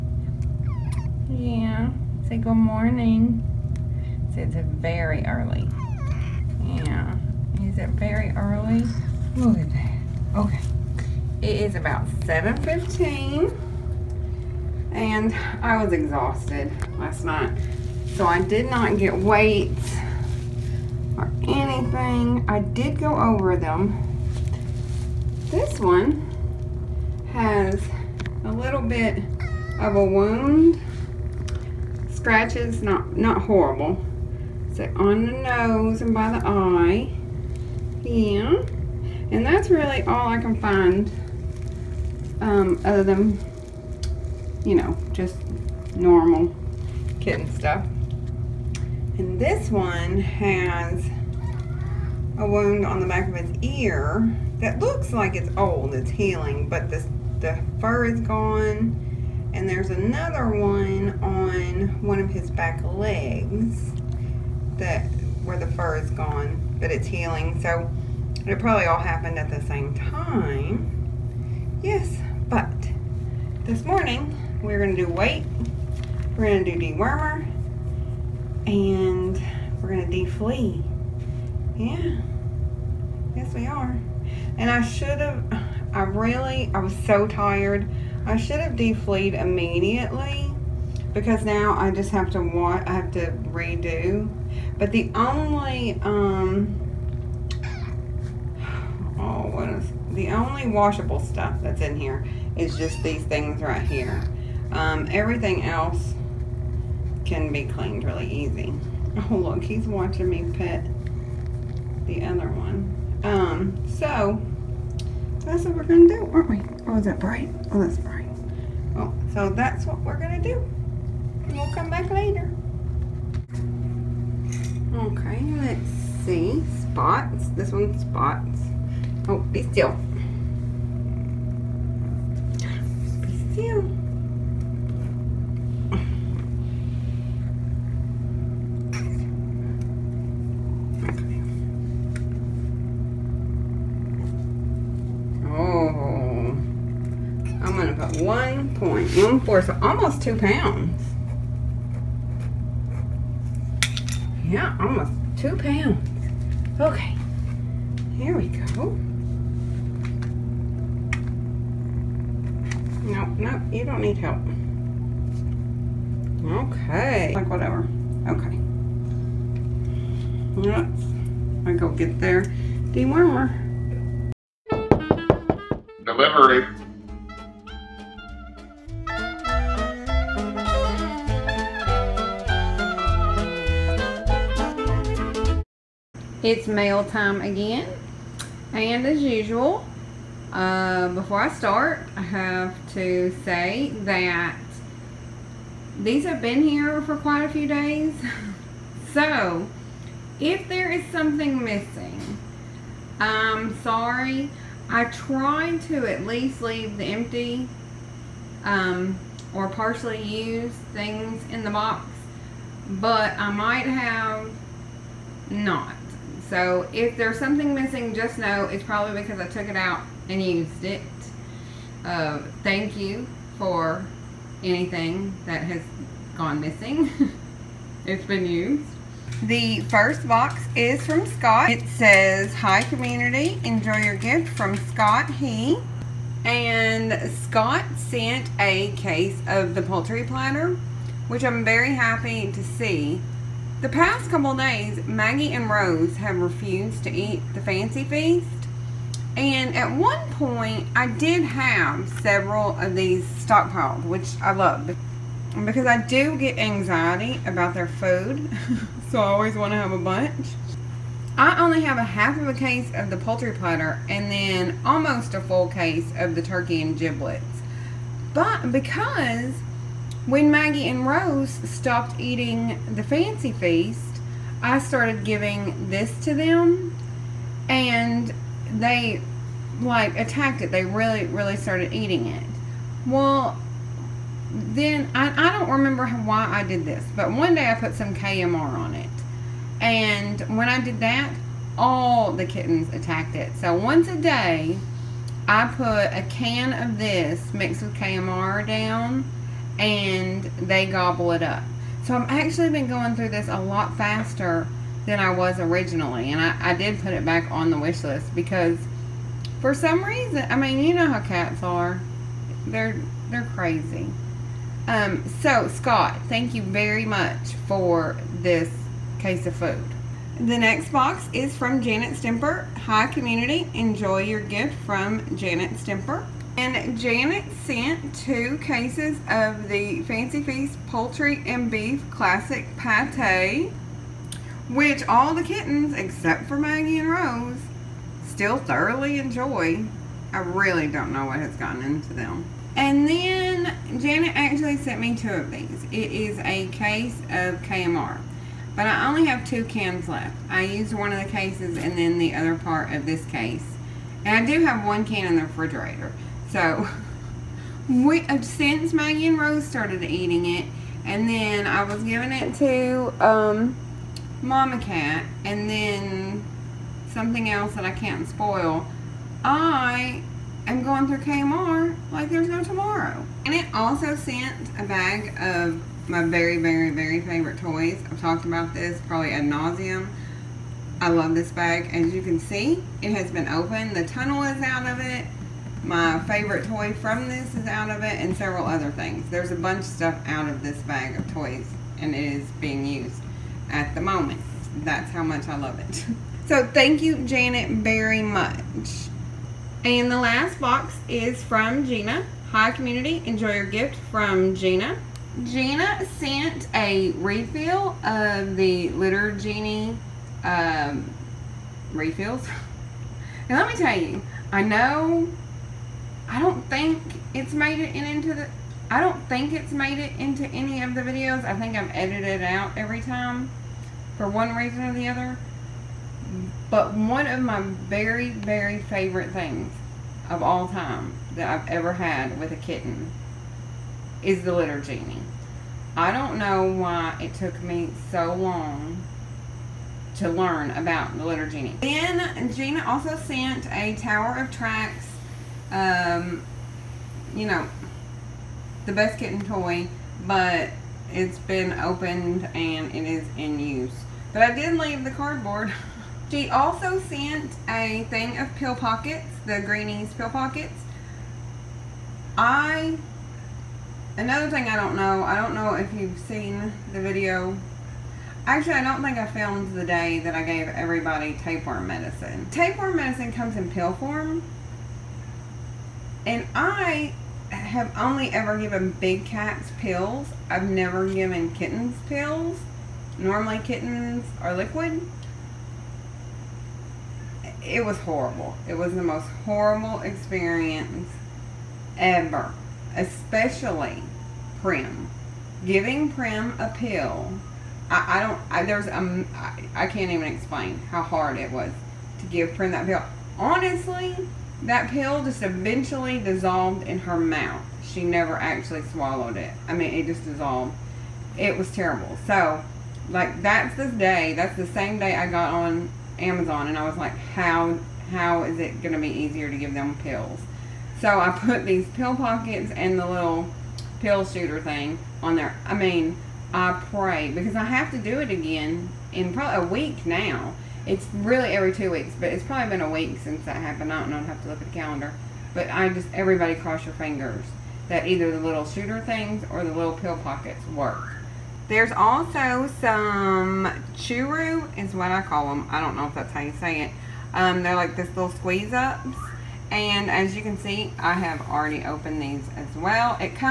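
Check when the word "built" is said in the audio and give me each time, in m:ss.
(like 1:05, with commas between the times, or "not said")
not said.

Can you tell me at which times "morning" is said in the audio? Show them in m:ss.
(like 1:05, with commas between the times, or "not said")
0:02, 1:13.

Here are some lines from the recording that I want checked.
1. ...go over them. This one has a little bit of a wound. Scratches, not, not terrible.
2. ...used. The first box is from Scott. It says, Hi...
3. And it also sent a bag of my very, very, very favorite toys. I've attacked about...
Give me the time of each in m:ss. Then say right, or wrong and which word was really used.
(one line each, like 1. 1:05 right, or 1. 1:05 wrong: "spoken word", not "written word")
1. 0:22 wrong: "horrible", not "terrible"
2. 3:48 right
3. 6:13 wrong: "talked", not "attacked".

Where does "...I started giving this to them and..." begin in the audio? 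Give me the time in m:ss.
4:34.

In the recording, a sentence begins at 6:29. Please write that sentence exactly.
There's a bunch of stuff out of this bag of toys and it is being used at the moment.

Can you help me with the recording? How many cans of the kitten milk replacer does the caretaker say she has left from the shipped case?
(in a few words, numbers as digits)
2.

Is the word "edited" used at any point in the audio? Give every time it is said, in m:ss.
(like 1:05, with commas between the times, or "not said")
7:01.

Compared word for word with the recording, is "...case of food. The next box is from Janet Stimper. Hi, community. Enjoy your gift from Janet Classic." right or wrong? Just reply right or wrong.
wrong.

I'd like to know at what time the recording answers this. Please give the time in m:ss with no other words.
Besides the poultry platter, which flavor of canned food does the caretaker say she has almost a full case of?
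4:26.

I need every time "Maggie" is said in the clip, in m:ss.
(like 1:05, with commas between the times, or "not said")
4:05, 4:30, 5:36, 5:58.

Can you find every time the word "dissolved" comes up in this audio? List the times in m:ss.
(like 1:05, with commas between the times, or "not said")
8:26, 8:30.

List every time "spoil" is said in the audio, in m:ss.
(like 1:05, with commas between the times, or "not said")
6:08.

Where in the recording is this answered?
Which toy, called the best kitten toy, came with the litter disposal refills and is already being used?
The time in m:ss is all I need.
7:23.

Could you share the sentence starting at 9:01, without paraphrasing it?
There's also some churu is what I call them.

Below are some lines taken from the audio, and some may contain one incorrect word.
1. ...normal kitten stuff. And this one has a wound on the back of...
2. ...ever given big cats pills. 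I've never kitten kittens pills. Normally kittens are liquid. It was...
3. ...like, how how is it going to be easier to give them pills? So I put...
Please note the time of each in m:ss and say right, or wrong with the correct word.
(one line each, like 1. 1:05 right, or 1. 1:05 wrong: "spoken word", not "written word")
1. 0:45 right
2. 7:58 wrong: "given", not "kitten"
3. 8:36 right.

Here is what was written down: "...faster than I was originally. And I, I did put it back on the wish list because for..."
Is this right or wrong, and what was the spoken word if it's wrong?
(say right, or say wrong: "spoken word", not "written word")
right.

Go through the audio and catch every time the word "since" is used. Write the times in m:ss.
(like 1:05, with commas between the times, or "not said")
5:58, 8:53.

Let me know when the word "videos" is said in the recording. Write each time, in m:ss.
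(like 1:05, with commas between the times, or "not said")
7:01, 7:47.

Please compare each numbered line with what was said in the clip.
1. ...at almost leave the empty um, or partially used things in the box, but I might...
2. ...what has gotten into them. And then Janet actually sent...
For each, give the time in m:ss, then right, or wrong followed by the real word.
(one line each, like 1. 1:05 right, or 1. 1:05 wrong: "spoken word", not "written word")
1. 3:26 wrong: "least", not "almost"
2. 5:41 right.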